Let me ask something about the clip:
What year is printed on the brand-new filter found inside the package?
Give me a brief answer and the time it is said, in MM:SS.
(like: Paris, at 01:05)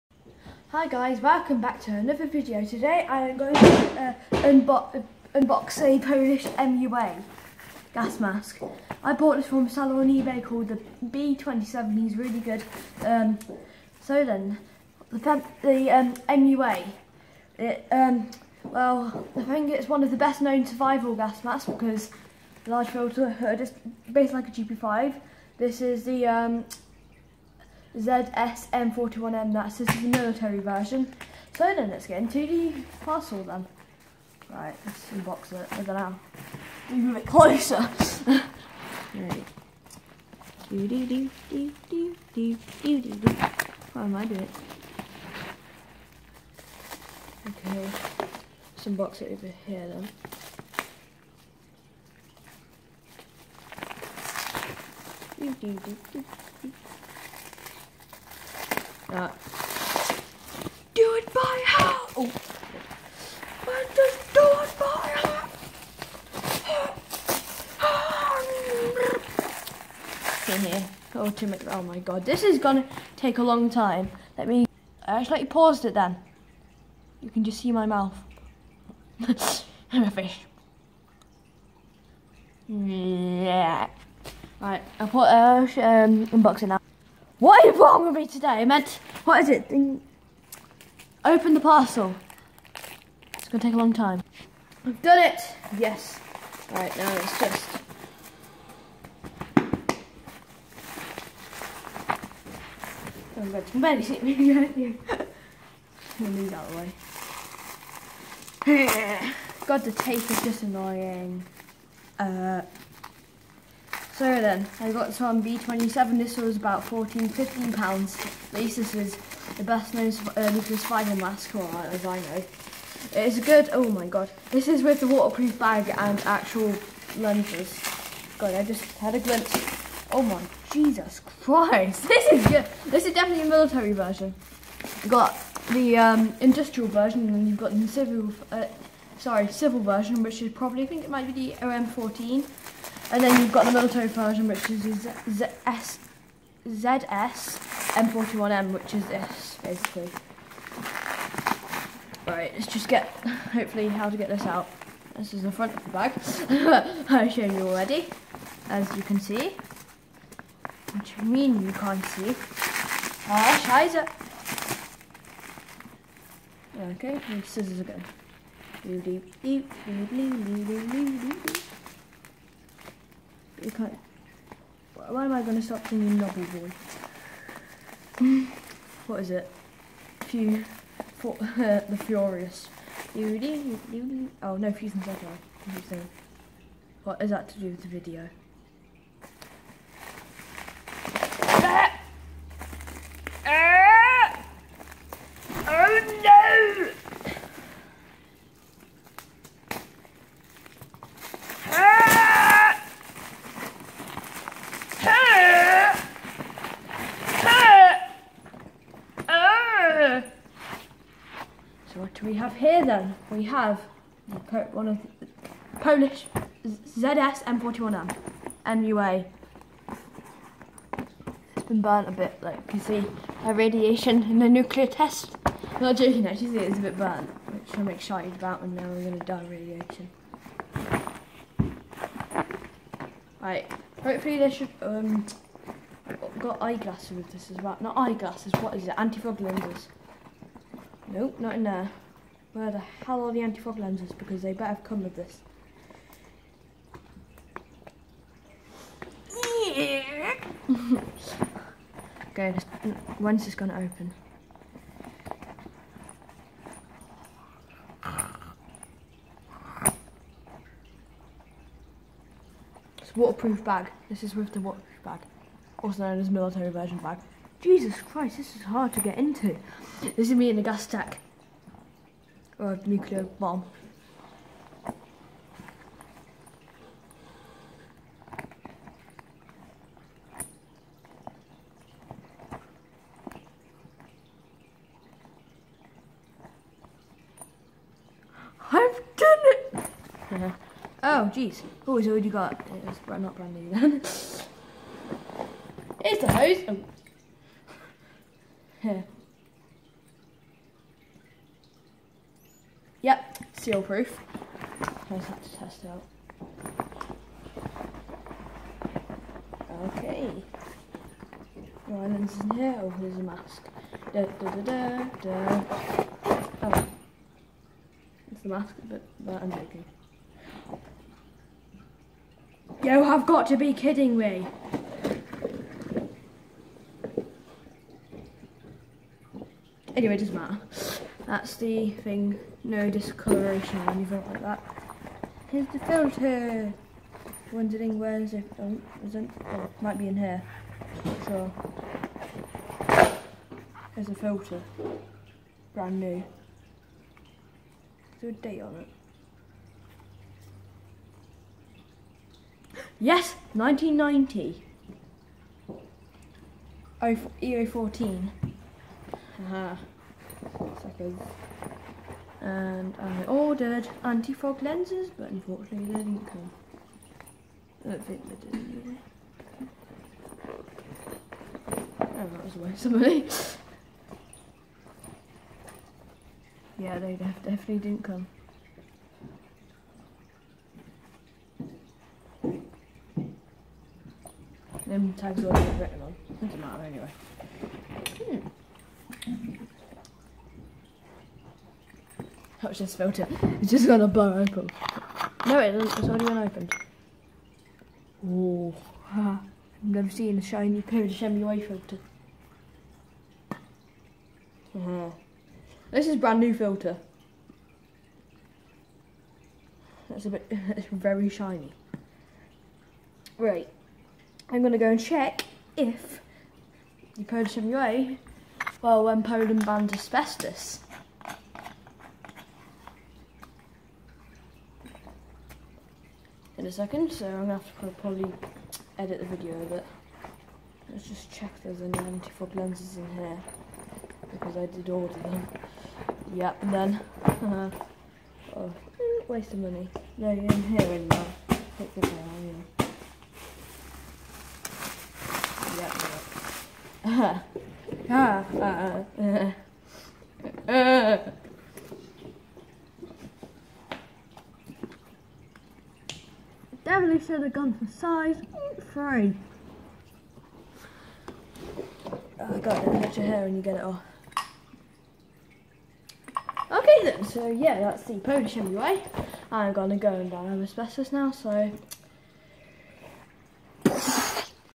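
1990, at 05:53.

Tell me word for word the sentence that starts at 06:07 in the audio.
I don't think they did anyway.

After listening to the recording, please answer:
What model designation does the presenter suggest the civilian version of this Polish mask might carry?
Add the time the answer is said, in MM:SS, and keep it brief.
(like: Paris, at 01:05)
OM14, at 02:21.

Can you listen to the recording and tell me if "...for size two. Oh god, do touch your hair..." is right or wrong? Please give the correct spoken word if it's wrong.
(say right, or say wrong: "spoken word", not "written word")
wrong: "three", not "two".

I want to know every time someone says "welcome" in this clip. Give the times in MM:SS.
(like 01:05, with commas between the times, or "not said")
00:01.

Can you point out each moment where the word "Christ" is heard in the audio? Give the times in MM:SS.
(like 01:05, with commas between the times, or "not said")
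02:11, 04:28.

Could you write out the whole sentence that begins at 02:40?
Which I mean you can't see.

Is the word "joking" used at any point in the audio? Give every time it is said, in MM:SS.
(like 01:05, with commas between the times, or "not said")
03:45, 05:19.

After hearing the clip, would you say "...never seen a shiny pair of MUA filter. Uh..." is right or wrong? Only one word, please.
right.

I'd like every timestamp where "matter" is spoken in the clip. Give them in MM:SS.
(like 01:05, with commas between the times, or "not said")
05:30, 06:26.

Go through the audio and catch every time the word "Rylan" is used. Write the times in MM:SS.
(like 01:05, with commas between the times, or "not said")
05:11.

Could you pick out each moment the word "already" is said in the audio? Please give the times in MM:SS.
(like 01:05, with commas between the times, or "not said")
02:37, 06:25, 06:36.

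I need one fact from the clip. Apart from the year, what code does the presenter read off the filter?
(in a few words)
EO14.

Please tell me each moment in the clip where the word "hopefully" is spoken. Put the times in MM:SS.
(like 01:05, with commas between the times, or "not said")
02:33, 03:54.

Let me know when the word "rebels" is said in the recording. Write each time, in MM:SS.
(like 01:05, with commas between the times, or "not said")
not said.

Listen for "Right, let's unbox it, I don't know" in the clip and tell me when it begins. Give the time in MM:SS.
00:34.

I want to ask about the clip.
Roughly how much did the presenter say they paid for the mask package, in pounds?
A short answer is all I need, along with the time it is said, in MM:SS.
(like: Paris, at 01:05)
14 to 15 pounds, at 01:56.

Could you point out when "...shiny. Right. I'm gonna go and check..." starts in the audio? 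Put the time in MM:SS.
06:51.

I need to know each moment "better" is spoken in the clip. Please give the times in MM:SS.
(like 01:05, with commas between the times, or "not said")
04:04.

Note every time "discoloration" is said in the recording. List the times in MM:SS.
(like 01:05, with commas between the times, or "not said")
05:32.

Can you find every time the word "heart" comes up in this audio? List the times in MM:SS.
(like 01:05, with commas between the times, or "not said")
01:01, 01:07.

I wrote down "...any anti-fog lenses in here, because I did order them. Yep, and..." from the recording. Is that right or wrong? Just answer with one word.
right.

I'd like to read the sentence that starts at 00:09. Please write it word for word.
I bought this from a seller on eBay called the B27, he's really good.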